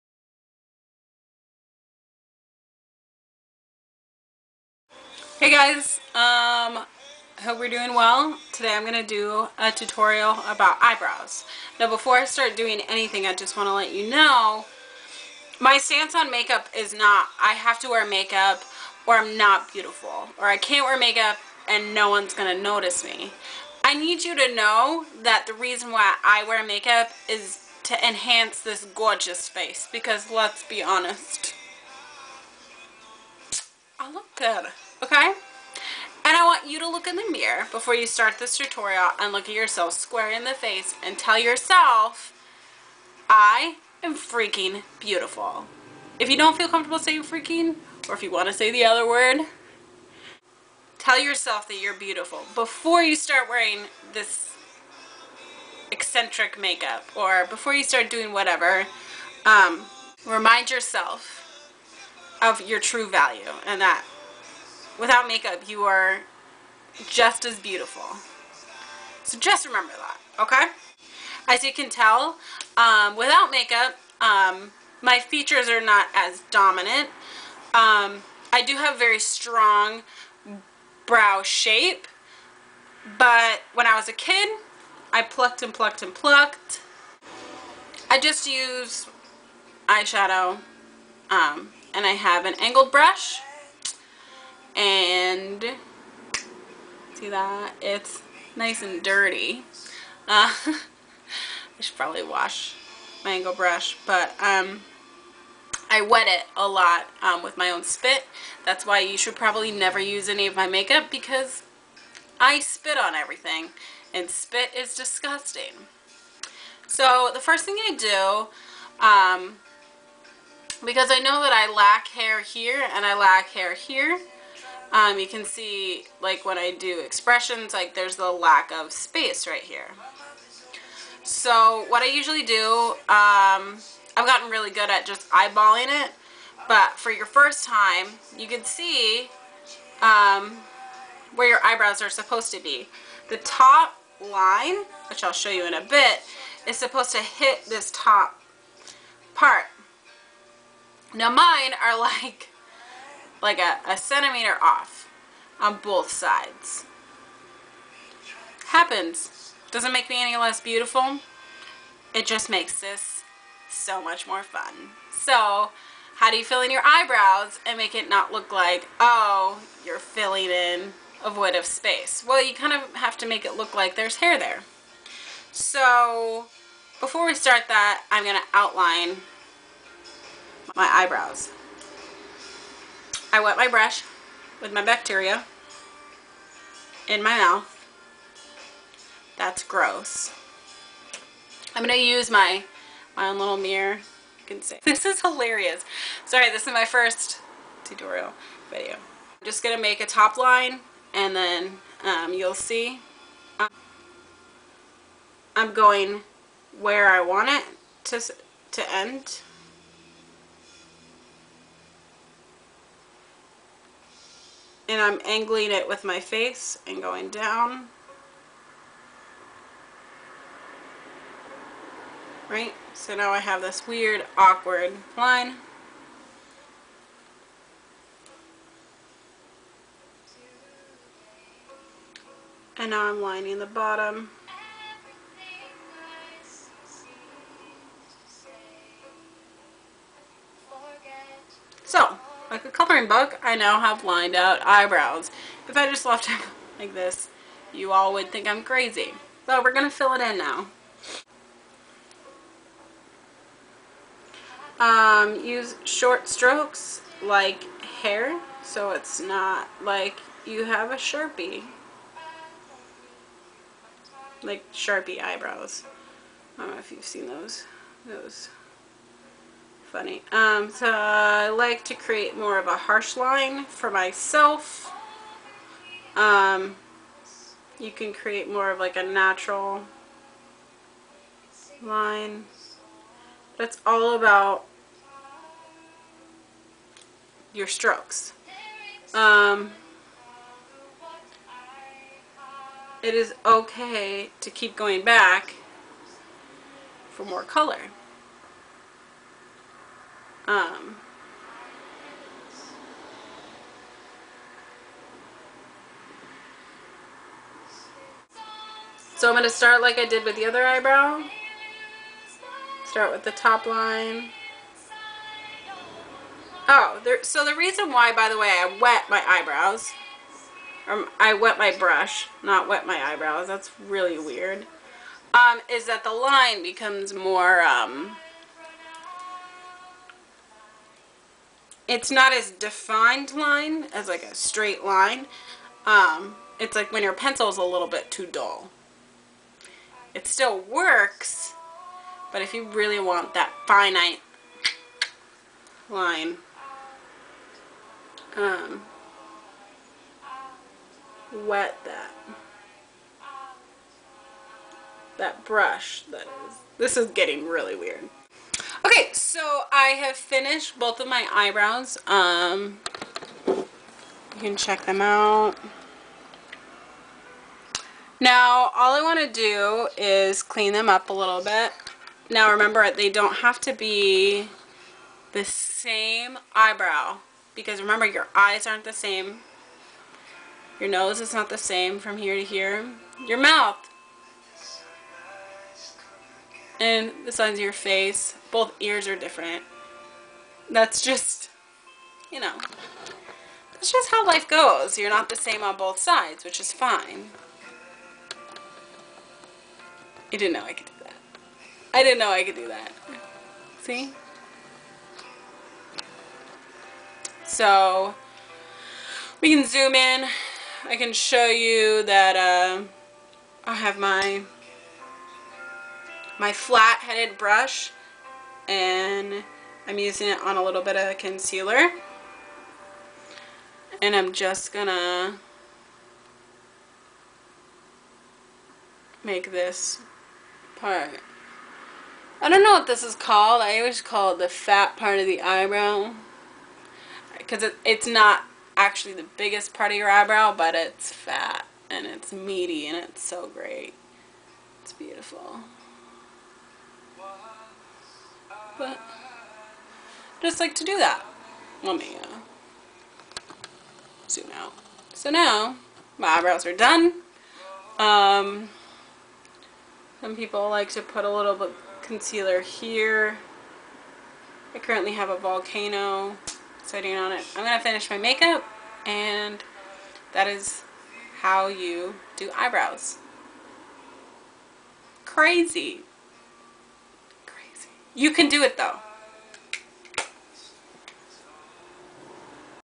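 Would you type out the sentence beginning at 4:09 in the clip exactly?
So we're going to fill it in now.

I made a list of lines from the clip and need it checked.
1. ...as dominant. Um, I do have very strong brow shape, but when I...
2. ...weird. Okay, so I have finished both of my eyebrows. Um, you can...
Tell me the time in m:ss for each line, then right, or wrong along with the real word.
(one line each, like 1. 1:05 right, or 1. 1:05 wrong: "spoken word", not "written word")
1. 1:16 right
2. 5:57 right.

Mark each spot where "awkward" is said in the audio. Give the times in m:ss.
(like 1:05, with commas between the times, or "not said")
3:44.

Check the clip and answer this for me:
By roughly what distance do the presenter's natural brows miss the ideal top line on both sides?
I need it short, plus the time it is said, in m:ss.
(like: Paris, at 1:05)
a centimeter, at 2:33.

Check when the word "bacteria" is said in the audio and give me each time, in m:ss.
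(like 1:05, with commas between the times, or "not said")
3:04.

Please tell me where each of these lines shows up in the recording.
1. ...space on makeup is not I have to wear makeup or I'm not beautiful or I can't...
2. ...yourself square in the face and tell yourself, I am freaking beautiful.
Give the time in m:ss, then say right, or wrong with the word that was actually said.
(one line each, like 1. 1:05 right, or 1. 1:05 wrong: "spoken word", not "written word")
1. 0:15 wrong: "stance", not "space"
2. 0:39 right.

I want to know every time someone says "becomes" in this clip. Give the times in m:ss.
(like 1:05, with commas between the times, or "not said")
5:26.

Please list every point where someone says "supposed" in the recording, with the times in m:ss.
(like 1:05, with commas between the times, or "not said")
2:22, 2:26.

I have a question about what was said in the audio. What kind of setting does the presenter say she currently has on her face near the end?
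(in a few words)
volcano.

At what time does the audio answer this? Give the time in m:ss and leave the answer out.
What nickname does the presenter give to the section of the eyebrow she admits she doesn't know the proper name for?
7:14.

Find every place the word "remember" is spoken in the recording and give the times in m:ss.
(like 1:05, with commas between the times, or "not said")
1:09, 6:12, 6:17.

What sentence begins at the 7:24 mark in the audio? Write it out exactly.
It's beautiful but I just like to do that.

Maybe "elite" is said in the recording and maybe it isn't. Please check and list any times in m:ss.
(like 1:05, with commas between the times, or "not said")
not said.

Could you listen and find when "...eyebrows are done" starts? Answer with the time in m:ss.
7:36.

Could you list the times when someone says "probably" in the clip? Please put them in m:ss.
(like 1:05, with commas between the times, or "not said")
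1:41, 1:49.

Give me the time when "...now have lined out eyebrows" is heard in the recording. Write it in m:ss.
4:03.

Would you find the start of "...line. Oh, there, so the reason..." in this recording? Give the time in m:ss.
5:13.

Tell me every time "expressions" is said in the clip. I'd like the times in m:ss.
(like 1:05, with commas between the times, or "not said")
2:07.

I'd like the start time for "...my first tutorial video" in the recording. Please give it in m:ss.
3:16.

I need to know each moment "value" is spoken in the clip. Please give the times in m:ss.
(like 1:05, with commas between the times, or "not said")
1:03.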